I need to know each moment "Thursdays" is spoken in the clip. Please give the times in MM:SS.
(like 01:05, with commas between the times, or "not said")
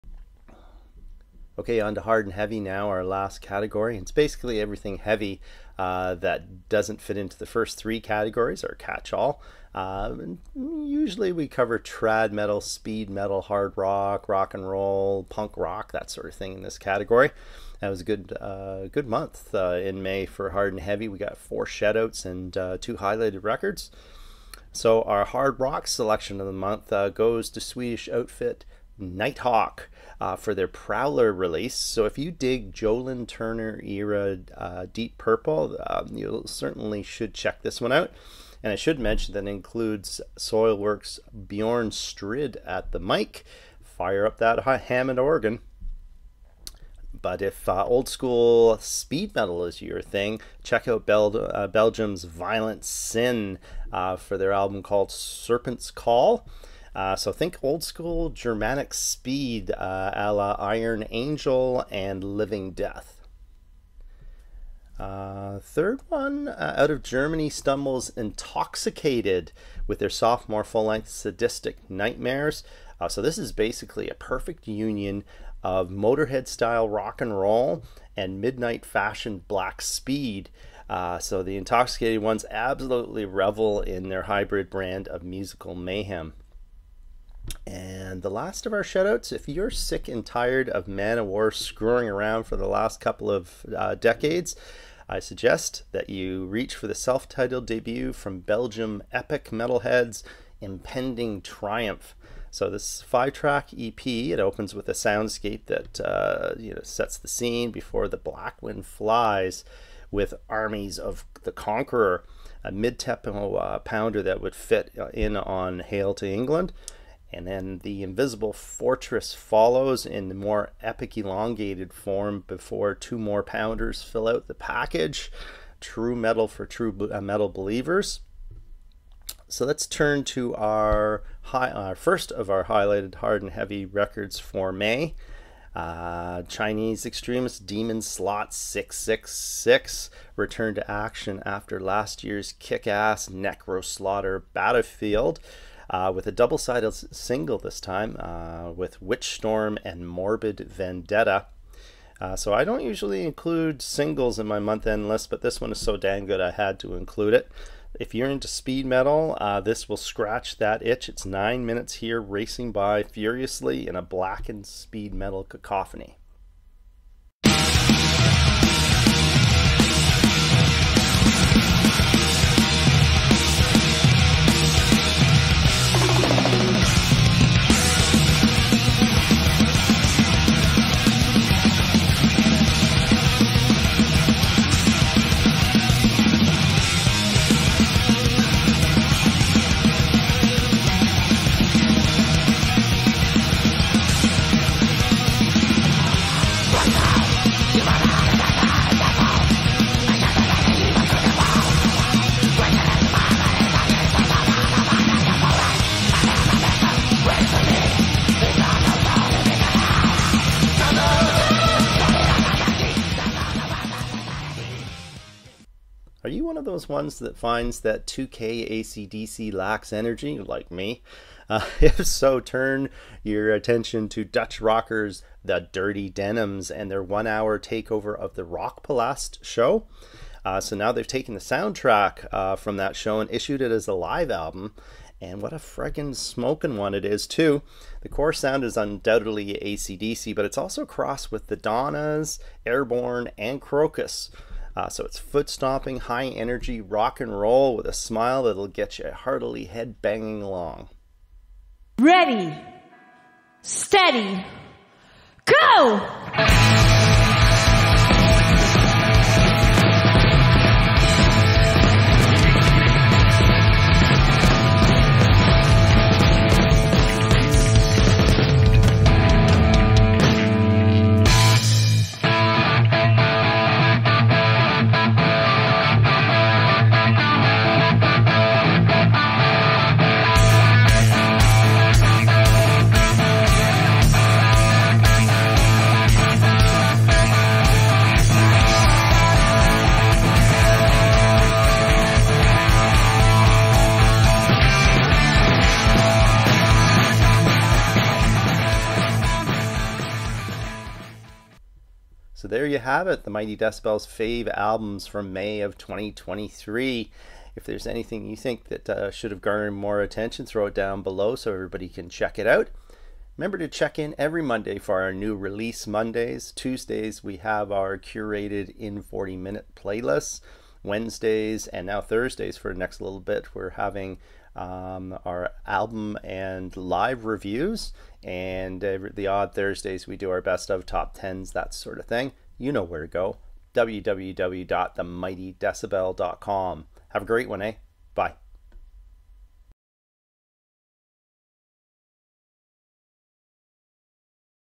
05:22, 05:29.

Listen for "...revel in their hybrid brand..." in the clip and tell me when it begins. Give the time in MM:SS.
01:23.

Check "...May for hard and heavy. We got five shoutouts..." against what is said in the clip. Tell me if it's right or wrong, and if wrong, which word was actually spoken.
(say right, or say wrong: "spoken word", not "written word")
wrong: "four", not "five".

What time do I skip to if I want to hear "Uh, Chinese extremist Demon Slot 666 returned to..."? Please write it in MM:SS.
02:15.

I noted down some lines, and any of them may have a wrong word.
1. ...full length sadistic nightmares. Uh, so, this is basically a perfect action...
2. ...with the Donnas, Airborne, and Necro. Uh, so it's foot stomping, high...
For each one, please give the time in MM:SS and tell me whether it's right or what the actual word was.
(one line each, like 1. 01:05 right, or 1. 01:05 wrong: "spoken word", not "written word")
1. 01:10 wrong: "union", not "action"
2. 04:01 wrong: "Krokus", not "Necro".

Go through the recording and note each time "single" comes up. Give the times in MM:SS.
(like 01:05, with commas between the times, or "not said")
02:26, 02:33.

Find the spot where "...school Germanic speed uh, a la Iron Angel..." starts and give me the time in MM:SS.
00:57.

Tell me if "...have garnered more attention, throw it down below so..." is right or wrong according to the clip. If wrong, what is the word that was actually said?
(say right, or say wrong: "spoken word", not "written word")
right.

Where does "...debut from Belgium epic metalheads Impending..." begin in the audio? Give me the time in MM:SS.
01:37.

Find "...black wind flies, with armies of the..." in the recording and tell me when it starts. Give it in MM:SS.
01:48.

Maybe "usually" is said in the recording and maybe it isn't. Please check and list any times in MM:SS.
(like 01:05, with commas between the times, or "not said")
00:10, 02:32.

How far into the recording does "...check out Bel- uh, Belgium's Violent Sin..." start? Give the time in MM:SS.
00:50.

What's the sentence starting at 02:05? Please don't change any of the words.
True metal for true uh, metal believers.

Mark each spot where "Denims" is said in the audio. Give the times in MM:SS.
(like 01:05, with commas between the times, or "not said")
03:46.